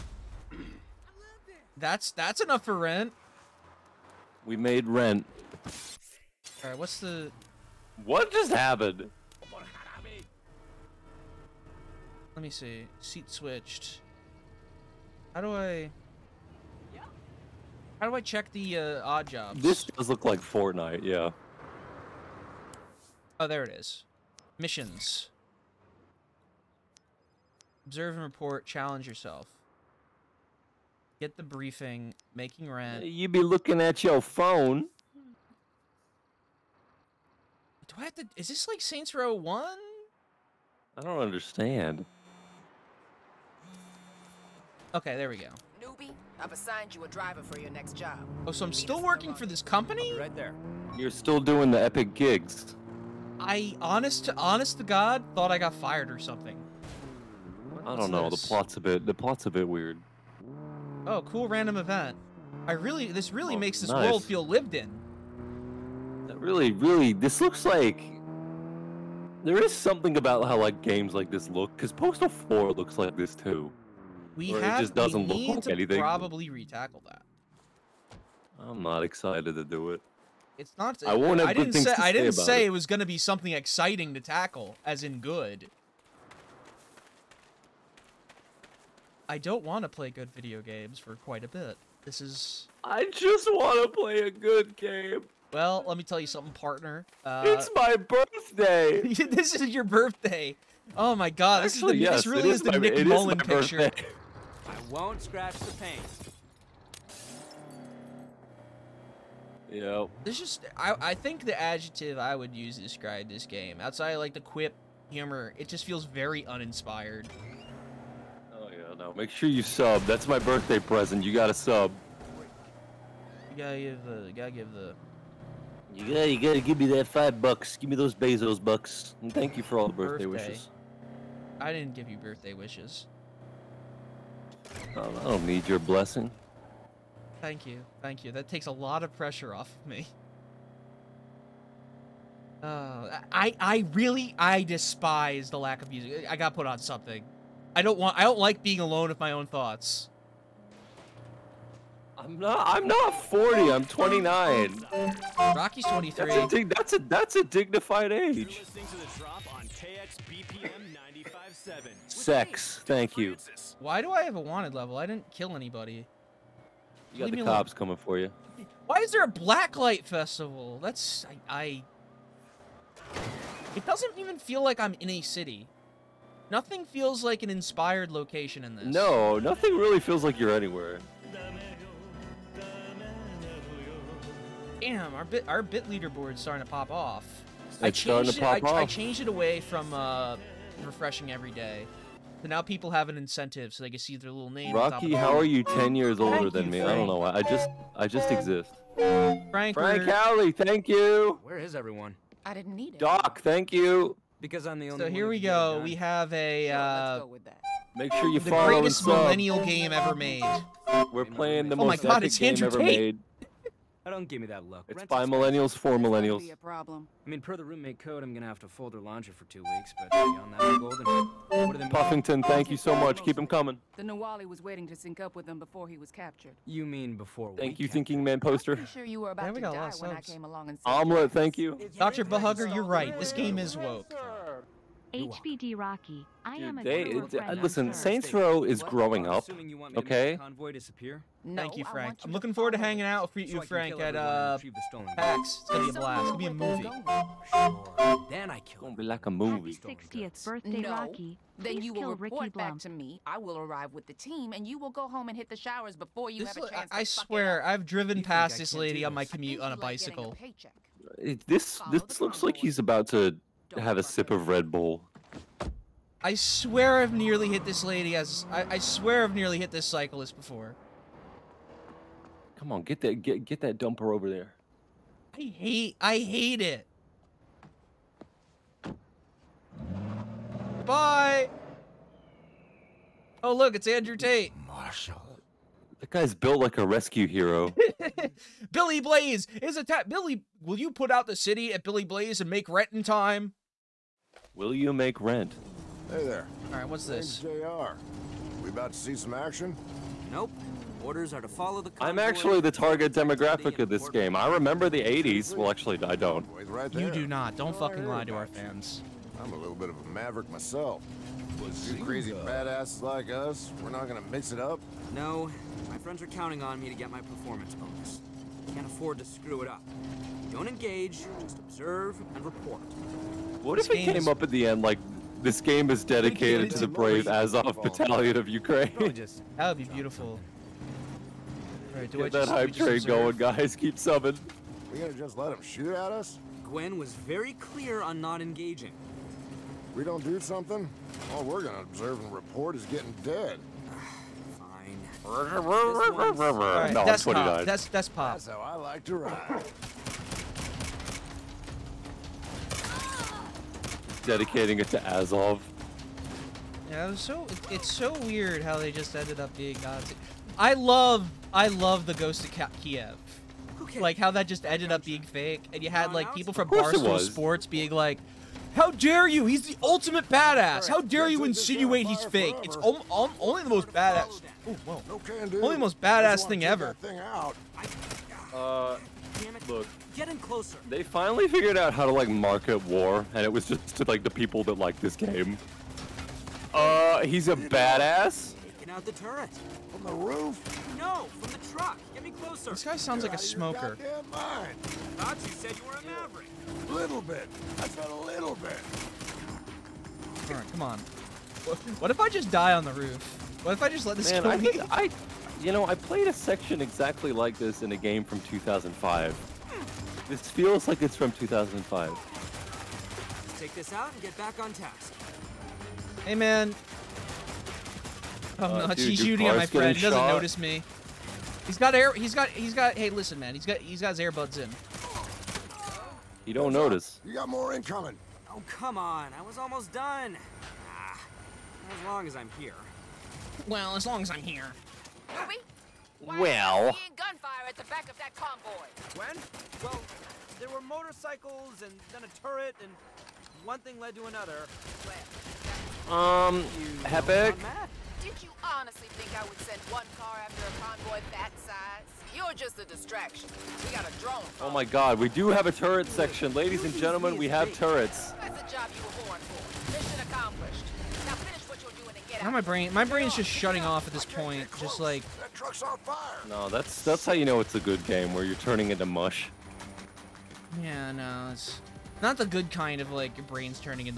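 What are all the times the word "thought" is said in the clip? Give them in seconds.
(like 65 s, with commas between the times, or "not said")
55 s, 149 s, 394 s.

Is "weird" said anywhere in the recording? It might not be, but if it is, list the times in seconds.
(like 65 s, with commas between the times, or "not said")
59 s, 358 s.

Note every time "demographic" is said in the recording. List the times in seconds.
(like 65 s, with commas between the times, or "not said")
303 s.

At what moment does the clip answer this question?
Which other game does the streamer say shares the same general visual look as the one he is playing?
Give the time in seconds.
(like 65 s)
71 s.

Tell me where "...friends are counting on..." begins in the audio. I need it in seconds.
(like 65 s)
315 s.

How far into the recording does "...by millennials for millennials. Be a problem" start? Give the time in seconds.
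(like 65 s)
215 s.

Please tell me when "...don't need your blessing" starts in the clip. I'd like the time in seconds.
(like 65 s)
135 s.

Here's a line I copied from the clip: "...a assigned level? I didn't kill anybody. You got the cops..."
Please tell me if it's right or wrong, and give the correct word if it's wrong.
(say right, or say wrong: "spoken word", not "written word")
wrong: "wanted", not "assigned".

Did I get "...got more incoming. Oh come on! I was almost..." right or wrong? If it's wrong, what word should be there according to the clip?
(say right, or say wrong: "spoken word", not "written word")
right.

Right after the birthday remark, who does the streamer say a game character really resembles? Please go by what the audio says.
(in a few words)
Nick Mullen.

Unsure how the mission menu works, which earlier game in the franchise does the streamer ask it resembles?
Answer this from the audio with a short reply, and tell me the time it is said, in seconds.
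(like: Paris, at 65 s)
Saints Row 1, at 38 s.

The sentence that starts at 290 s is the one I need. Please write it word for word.
Billy, will you put out the city at Billy Blaze and make rent in time?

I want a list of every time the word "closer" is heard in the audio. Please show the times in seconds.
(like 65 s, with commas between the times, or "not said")
380 s, 392 s.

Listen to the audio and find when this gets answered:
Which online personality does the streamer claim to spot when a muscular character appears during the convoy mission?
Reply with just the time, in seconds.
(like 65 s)
283 s.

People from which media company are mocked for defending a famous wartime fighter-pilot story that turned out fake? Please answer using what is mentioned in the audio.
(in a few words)
Barstool Sports.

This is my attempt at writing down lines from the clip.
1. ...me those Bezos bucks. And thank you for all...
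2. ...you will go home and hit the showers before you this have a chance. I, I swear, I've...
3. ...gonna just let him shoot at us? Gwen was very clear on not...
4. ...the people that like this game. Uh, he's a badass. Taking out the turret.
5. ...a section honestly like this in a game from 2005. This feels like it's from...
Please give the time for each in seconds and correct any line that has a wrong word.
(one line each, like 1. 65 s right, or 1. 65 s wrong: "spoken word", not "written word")
1. 127 s right
2. 254 s right
3. 334 s right
4. 384 s right
5. 406 s wrong: "exactly", not "honestly".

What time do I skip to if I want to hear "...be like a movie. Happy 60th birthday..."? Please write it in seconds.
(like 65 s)
248 s.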